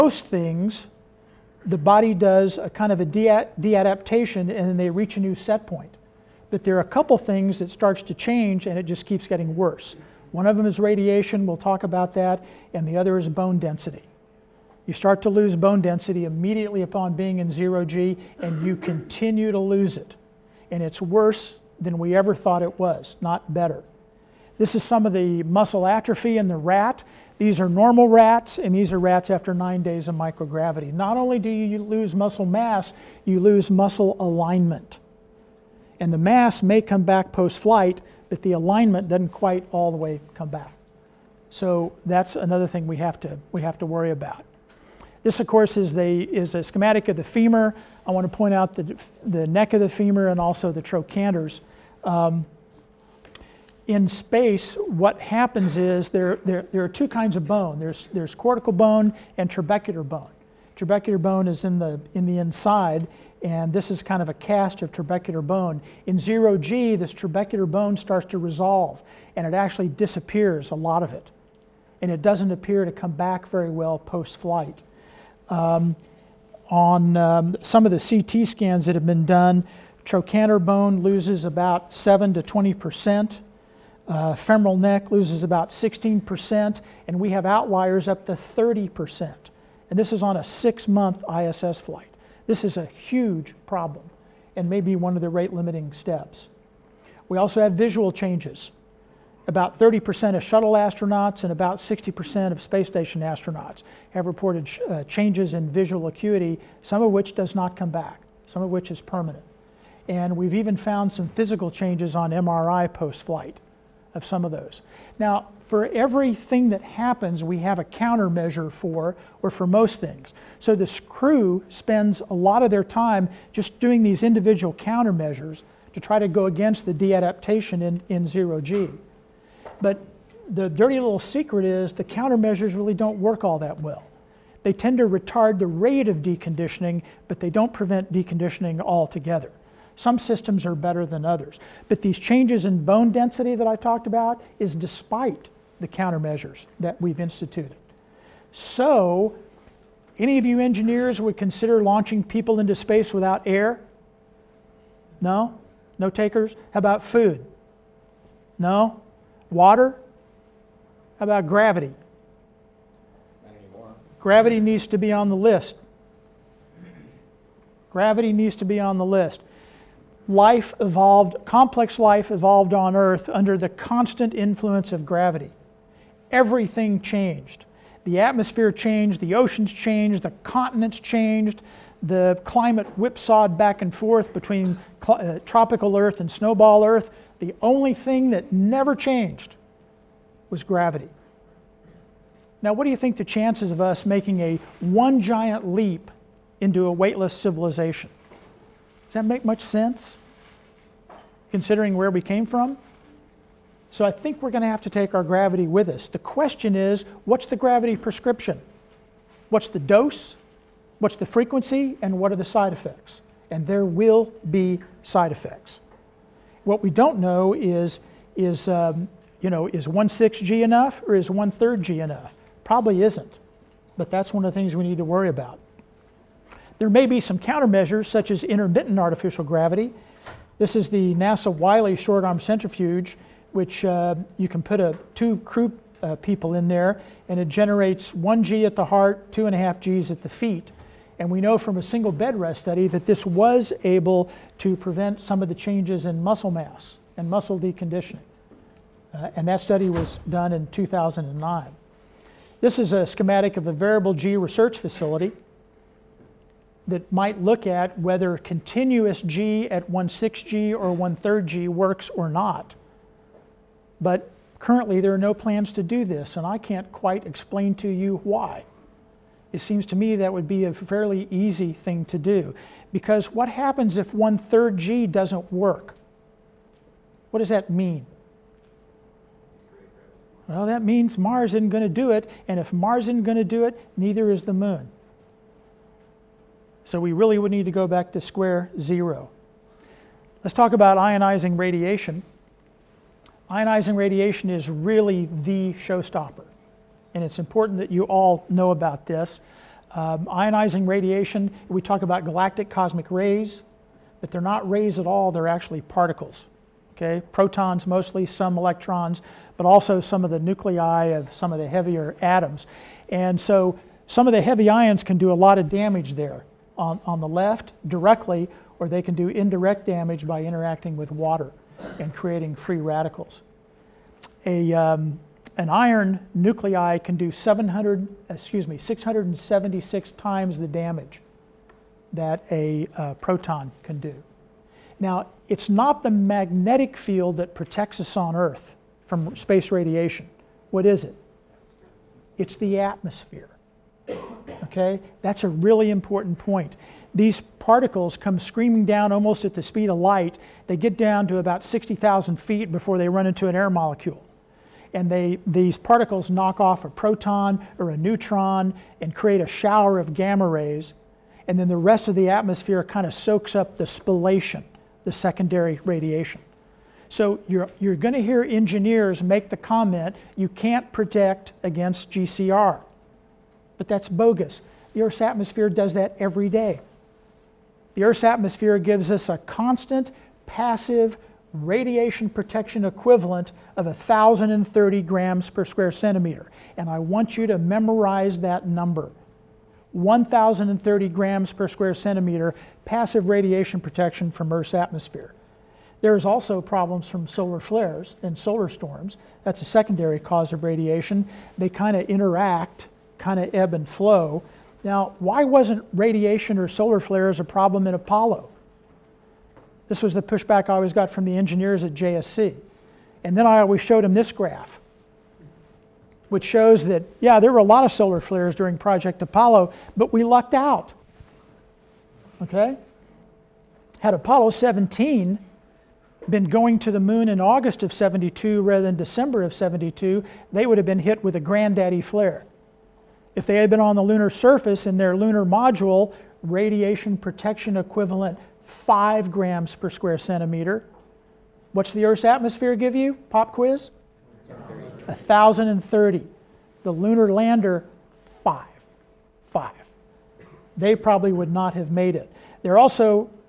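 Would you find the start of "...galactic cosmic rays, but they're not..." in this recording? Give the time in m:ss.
5:02.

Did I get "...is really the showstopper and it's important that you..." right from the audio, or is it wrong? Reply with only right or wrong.
right.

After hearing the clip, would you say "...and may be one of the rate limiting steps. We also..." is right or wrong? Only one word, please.
right.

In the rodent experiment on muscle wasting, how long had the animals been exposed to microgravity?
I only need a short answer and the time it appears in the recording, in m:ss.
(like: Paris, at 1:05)
9 days, at 0:29.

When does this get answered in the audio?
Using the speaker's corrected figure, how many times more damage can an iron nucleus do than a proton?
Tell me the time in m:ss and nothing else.
5:28.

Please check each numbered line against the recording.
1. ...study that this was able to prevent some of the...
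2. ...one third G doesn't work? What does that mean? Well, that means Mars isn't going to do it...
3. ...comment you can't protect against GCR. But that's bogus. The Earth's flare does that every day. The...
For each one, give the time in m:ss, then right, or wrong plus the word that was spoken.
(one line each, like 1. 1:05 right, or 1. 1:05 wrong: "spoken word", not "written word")
1. 4:02 right
2. 4:34 right
3. 6:09 wrong: "atmosphere", not "flare".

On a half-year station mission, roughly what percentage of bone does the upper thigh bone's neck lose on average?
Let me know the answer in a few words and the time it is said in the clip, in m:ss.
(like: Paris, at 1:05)
16 percent, at 1:25.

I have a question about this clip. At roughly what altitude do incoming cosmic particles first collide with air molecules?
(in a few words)
60,000 feet.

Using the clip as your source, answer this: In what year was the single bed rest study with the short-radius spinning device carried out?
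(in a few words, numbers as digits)
2009.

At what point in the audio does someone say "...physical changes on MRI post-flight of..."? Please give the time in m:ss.
1:51.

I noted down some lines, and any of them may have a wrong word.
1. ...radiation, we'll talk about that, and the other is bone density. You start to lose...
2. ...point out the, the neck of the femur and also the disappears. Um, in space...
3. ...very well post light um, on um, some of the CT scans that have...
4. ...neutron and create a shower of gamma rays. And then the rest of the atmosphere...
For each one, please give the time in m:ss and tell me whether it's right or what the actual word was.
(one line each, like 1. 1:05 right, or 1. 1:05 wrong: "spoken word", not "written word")
1. 0:10 right
2. 0:48 wrong: "trochanters", not "disappears"
3. 1:13 wrong: "flight", not "light"
4. 5:57 right.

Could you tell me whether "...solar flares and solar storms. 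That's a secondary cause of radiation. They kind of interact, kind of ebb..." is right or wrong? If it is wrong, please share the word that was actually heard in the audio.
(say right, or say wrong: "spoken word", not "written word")
right.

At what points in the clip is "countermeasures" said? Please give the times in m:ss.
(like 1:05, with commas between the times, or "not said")
1:57, 2:04, 2:12, 2:25, 3:47.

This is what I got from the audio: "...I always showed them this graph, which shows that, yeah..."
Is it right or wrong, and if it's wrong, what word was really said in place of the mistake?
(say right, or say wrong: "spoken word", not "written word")
right.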